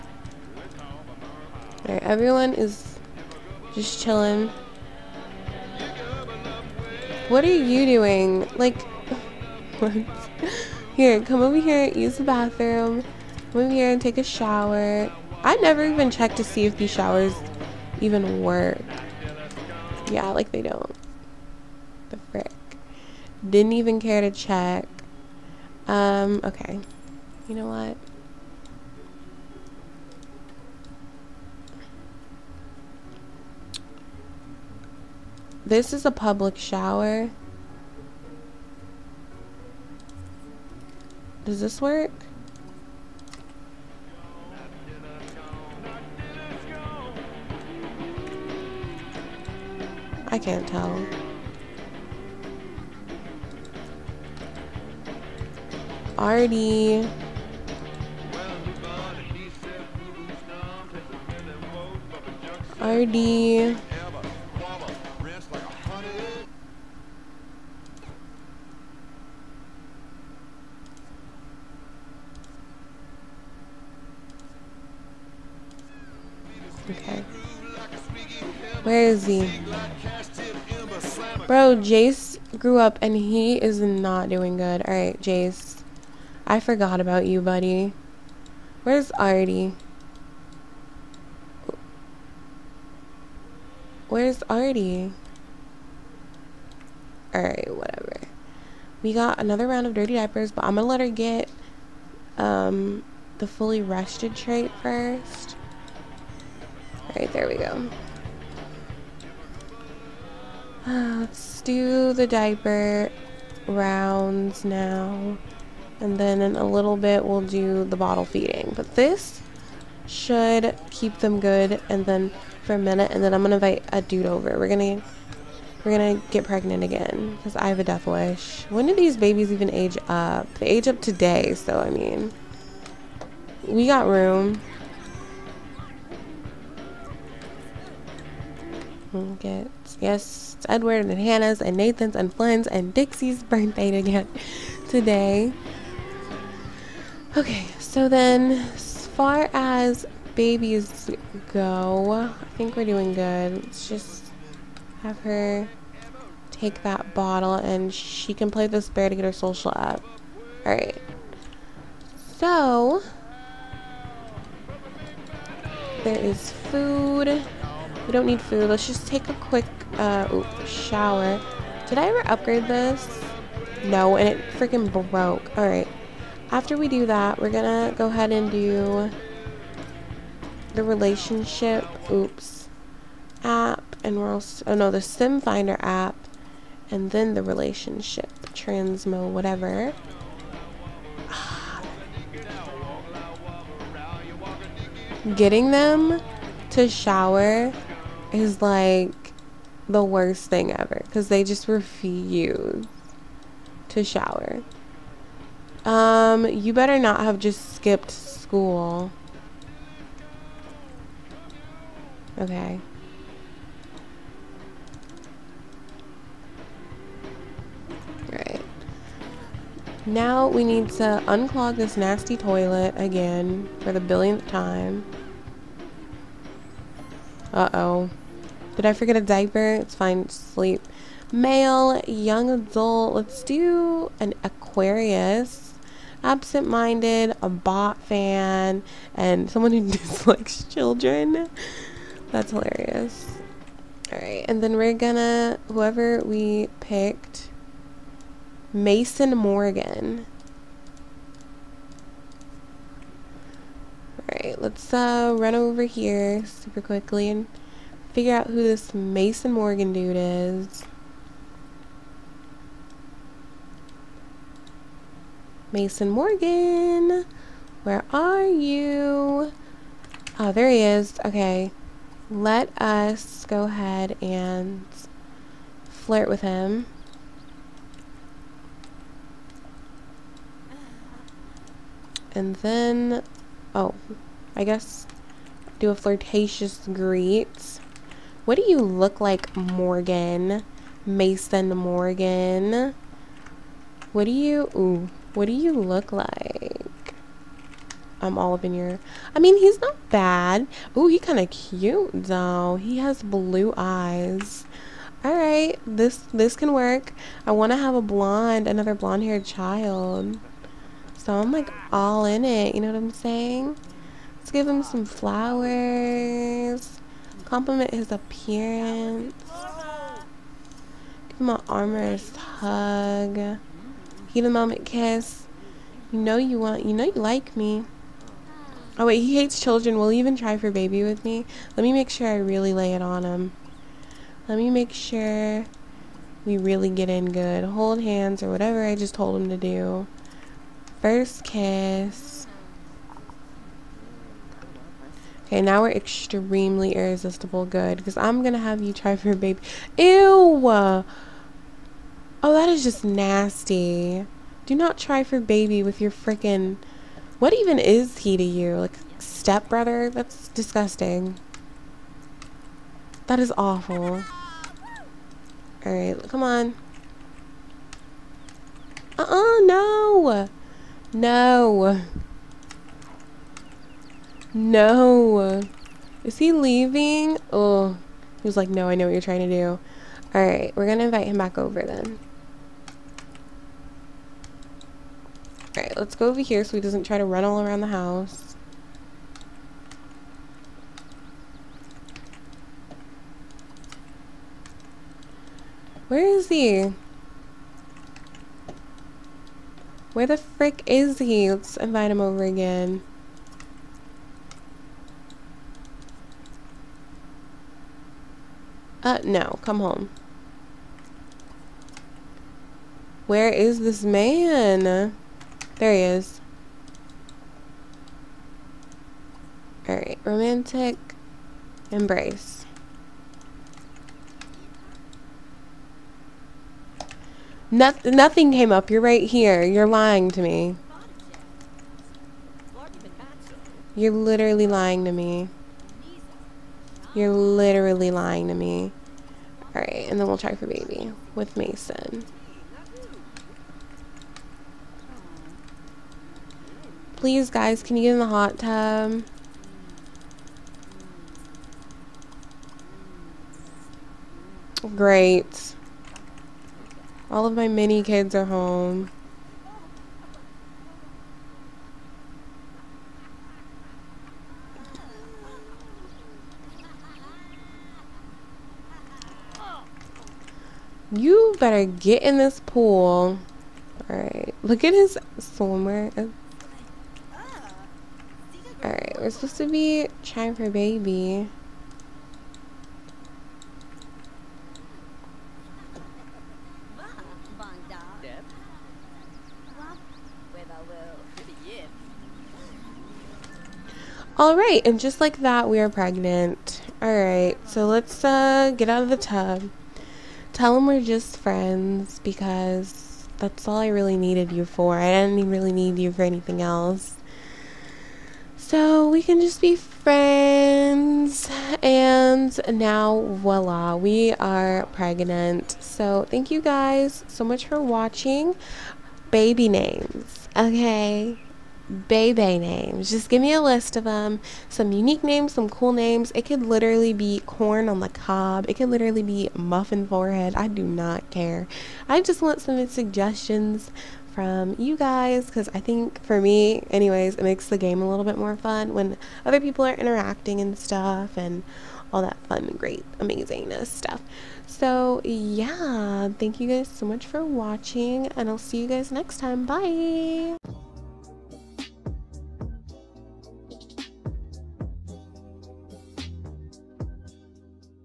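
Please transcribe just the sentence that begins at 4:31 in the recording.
Okay, let us go ahead and flirt with him.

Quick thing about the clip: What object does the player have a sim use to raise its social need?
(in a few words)
bear.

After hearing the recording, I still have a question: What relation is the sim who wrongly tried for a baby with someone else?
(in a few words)
stepbrother.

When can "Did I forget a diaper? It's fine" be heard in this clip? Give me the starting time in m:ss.
3:48.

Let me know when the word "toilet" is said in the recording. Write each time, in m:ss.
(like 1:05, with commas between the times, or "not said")
3:42.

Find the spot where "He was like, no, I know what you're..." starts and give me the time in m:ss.
6:18.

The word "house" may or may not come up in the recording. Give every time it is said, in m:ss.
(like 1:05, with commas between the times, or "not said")
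6:27.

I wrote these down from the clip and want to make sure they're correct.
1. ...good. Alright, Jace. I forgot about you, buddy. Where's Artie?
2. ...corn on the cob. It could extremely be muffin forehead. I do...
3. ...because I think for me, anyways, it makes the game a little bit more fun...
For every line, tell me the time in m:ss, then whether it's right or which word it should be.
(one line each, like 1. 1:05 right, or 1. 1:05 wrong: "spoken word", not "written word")
1. 1:24 right
2. 8:47 wrong: "literally", not "extremely"
3. 8:55 right.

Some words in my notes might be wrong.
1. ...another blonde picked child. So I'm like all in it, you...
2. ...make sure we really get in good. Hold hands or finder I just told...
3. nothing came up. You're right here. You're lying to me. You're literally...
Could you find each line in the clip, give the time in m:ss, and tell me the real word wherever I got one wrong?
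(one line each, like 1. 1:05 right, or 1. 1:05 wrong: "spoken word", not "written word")
1. 5:08 wrong: "haired", not "picked"
2. 5:34 wrong: "whatever", not "finder"
3. 7:07 right.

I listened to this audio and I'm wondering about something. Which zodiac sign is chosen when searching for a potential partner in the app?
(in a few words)
Aquarius.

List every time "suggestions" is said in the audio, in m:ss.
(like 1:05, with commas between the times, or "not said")
8:52.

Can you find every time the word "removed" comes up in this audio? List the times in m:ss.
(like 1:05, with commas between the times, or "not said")
not said.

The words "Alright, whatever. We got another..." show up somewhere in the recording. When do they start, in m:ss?
1:37.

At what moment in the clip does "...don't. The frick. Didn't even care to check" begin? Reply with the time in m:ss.
0:20.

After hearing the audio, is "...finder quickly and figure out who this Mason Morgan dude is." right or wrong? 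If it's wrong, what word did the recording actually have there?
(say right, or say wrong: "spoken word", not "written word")
wrong: "super", not "finder".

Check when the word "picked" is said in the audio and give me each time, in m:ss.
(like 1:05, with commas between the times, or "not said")
4:06.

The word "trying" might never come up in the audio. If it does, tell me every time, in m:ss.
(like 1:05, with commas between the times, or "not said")
6:19, 8:00.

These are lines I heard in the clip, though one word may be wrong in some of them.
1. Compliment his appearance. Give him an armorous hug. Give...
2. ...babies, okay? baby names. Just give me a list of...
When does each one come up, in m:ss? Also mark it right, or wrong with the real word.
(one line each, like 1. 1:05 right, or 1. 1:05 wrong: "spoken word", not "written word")
1. 5:17 right
2. 8:39 wrong: "names", not "babies".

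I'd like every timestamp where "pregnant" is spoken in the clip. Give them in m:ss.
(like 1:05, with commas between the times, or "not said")
2:06, 8:15, 8:34.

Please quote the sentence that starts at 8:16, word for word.
All right, so let's uh, get out of the tub.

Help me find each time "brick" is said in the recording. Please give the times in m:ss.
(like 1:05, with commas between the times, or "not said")
not said.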